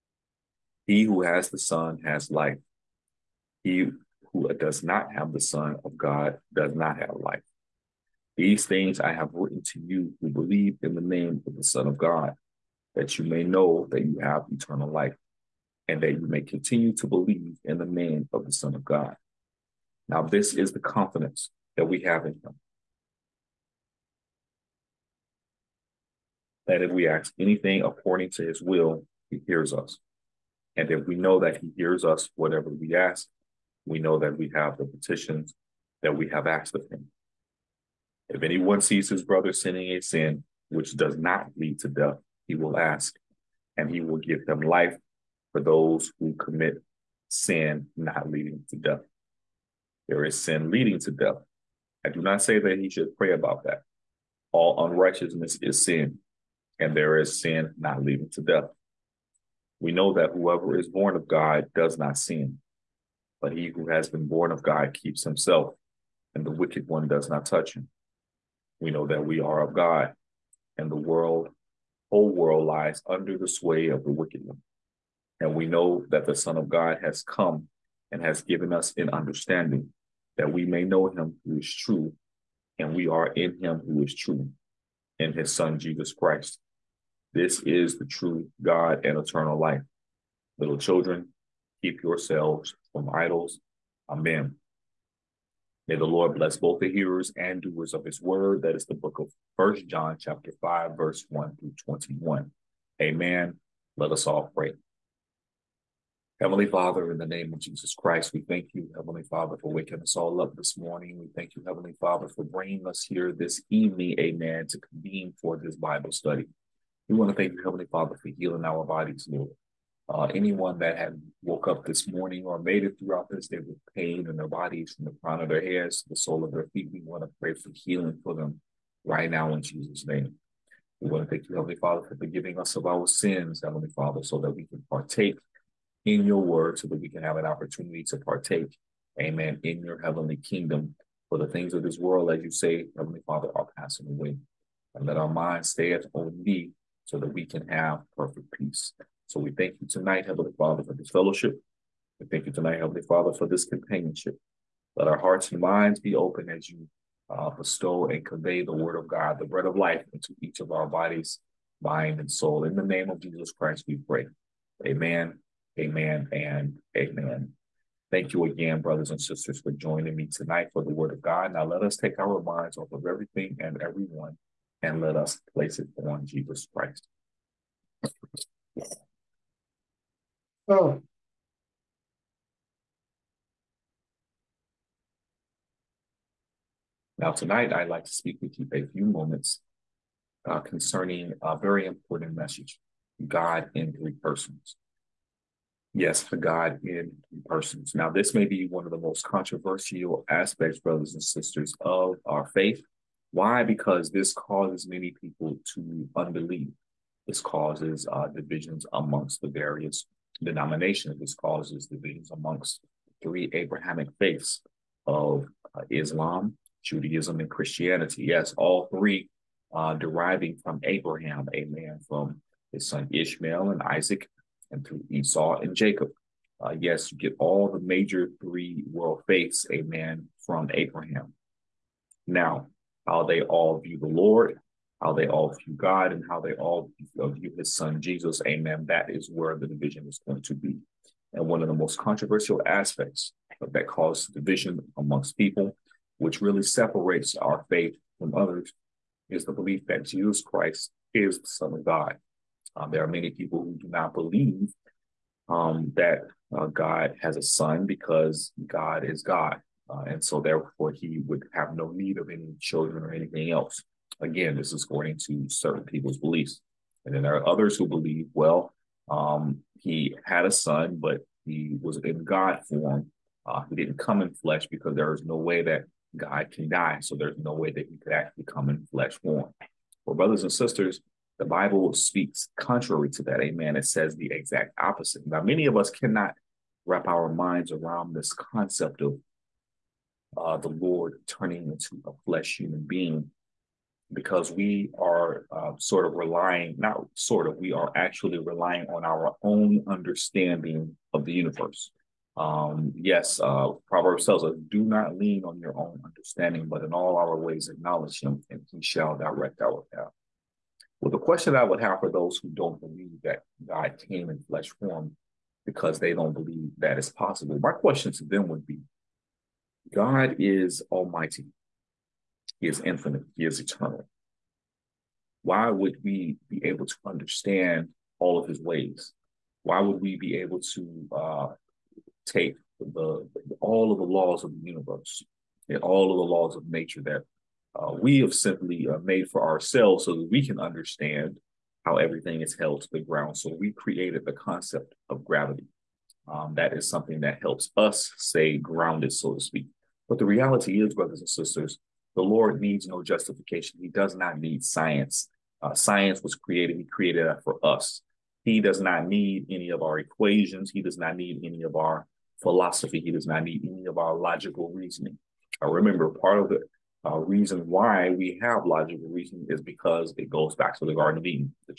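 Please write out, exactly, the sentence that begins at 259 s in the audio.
Uh, and so therefore he would have no need of any children or anything else.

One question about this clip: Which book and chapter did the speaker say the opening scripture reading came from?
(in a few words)
First John chapter 5.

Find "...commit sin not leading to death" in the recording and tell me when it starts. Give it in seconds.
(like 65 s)
46 s.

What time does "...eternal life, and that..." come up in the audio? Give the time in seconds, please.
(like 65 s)
14 s.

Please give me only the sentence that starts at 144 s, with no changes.
And let our minds stay on thee, so that we can have perfect peace.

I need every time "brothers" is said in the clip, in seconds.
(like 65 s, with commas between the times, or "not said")
39 s, 168 s, 200 s, 280 s, 350 s.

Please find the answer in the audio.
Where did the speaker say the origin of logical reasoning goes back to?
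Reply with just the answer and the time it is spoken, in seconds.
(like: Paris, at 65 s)
The Garden of Eden, at 370 s.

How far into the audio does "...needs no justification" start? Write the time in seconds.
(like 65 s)
352 s.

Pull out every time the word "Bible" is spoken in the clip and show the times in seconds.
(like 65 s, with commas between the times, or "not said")
115 s, 281 s.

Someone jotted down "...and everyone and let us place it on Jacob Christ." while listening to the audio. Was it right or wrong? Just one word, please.
wrong.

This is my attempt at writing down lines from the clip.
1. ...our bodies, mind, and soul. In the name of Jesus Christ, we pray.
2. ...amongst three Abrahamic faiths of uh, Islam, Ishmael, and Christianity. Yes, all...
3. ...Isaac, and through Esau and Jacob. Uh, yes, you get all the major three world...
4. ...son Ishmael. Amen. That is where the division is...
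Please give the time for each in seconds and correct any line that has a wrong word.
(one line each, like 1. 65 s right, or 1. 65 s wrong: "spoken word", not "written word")
1. 160 s right
2. 212 s wrong: "Judaism", not "Ishmael"
3. 223 s right
4. 237 s wrong: "Jesus", not "Ishmael".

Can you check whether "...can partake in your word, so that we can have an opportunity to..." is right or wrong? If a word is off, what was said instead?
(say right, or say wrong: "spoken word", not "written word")
right.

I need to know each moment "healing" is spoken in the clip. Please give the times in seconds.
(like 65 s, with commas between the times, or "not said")
118 s, 127 s.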